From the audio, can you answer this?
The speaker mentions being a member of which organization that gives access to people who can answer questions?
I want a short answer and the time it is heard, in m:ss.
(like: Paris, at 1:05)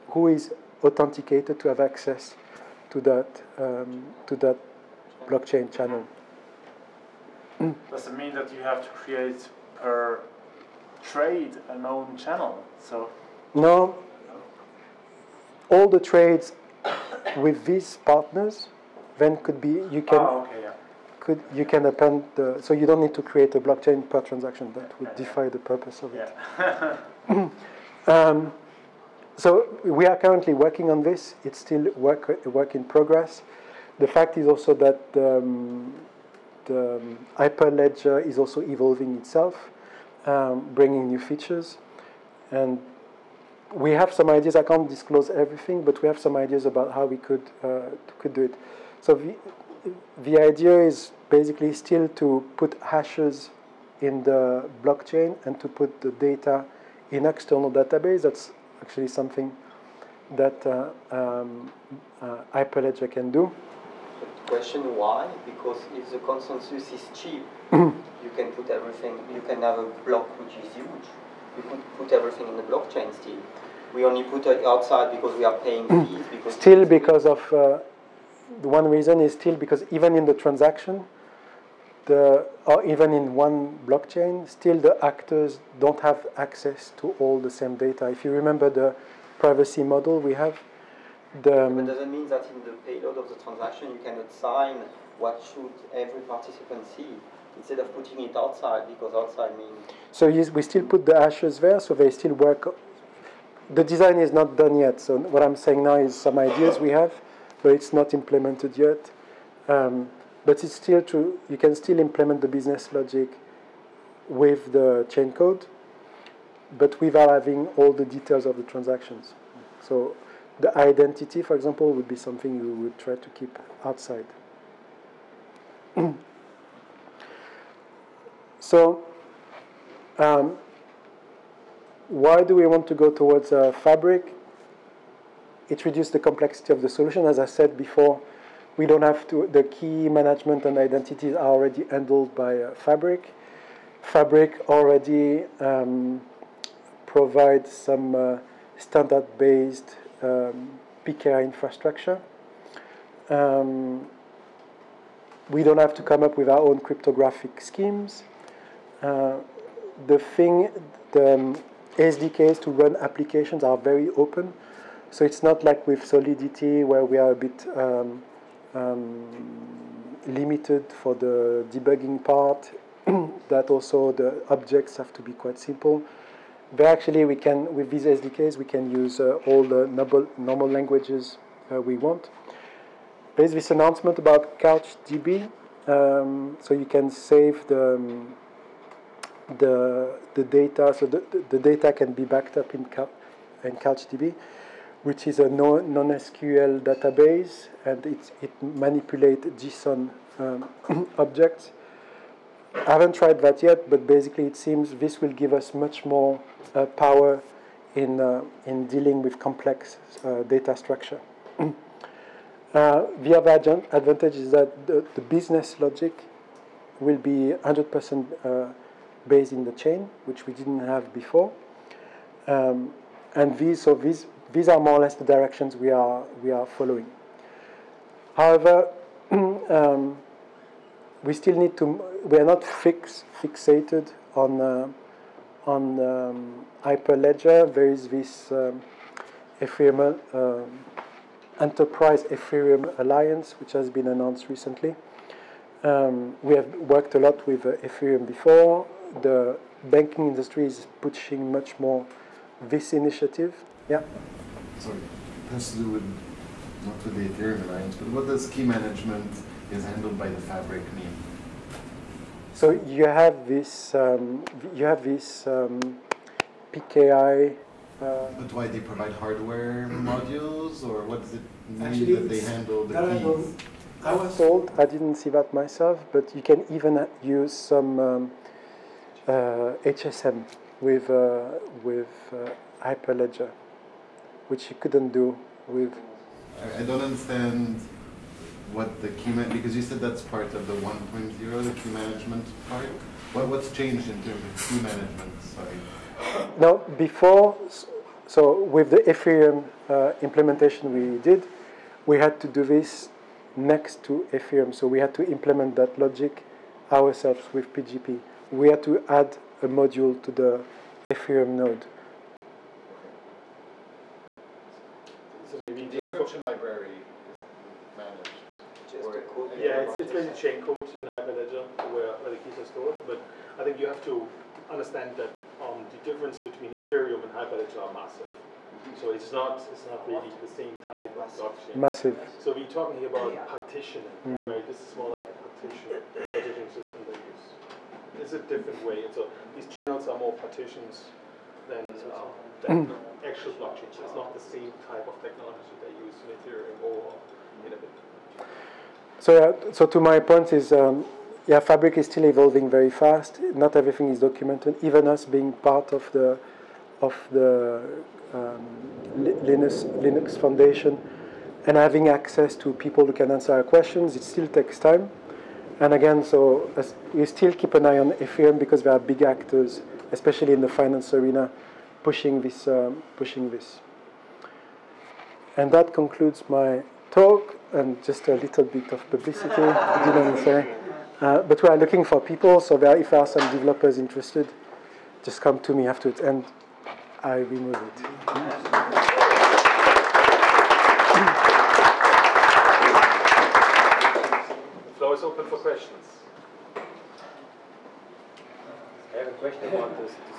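Linux Foundation, at 6:00.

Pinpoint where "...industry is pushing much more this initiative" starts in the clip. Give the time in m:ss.
4:10.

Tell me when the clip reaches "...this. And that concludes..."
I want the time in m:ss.
6:13.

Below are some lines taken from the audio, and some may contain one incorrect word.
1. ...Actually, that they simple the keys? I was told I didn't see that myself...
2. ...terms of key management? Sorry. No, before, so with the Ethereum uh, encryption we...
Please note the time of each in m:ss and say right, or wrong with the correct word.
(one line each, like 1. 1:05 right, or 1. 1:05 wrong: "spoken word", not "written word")
1. 4:31 wrong: "handle", not "simple"
2. 4:54 wrong: "implementation", not "encryption".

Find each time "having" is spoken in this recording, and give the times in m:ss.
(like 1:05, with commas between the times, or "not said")
1:57, 6:01.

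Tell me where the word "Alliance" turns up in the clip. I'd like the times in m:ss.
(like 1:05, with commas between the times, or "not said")
4:02, 4:17.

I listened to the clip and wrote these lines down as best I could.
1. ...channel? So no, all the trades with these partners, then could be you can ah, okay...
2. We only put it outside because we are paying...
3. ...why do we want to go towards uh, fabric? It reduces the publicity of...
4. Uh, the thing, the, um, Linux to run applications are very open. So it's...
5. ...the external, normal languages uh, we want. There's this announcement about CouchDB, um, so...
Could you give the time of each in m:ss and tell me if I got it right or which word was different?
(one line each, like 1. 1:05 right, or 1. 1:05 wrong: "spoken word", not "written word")
1. 0:12 right
2. 1:13 right
3. 2:12 wrong: "complexity", not "publicity"
4. 2:39 wrong: "SDKs", not "Linux"
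5. 2:59 wrong: "normal", not "external".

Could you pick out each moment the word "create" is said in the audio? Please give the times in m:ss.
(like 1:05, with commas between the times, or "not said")
0:09, 0:23.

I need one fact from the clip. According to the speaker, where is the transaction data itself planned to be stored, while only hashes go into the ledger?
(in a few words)
External database.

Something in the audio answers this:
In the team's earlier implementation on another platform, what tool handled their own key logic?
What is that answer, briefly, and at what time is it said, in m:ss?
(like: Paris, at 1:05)
PGP, at 5:07.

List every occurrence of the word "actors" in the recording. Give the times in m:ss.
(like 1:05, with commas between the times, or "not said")
1:25, 6:09.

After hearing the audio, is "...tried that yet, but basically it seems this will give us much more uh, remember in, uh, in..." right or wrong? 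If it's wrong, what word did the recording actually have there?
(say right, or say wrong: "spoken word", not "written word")
wrong: "power", not "remember".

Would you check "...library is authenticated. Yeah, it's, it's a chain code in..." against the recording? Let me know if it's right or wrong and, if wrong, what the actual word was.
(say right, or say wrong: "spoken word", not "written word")
wrong: "managed", not "authenticated".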